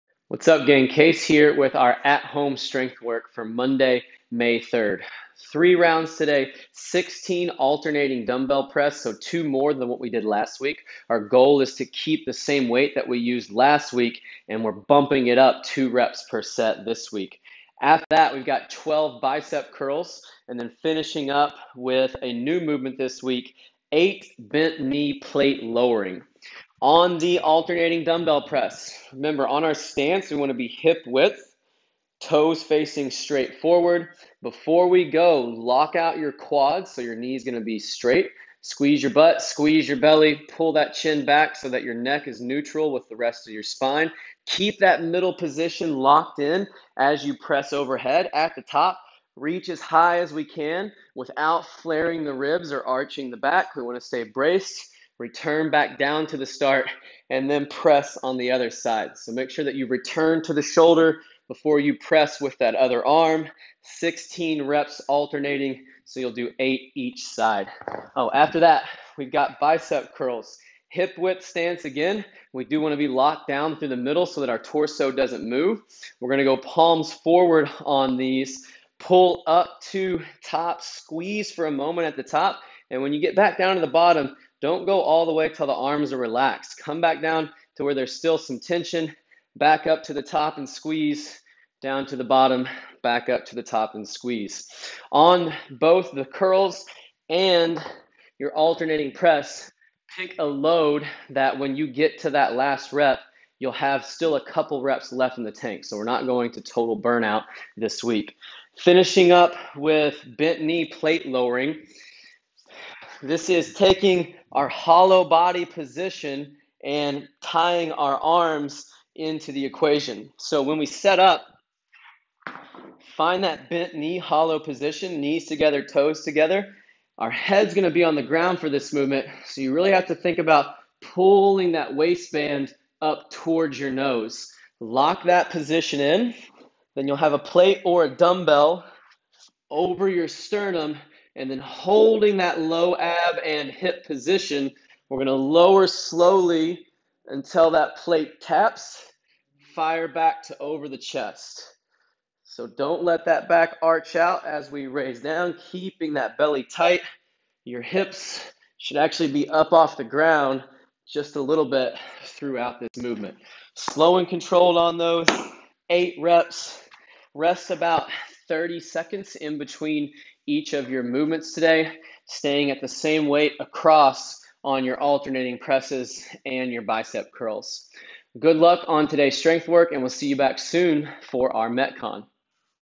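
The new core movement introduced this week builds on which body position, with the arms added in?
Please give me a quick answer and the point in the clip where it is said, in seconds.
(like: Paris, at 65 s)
Hollow body position, at 114 s.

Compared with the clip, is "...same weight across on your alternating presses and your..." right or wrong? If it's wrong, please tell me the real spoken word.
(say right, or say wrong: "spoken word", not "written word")
right.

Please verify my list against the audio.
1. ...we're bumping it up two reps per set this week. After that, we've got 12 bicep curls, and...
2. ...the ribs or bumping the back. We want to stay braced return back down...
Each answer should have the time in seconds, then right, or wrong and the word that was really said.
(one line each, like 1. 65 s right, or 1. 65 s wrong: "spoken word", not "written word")
1. 14 s right
2. 52 s wrong: "arching", not "bumping".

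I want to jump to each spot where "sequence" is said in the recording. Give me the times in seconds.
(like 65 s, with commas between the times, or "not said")
not said.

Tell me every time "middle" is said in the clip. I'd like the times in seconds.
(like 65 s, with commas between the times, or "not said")
45 s, 73 s.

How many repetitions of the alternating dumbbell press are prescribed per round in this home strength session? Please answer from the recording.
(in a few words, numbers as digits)
16.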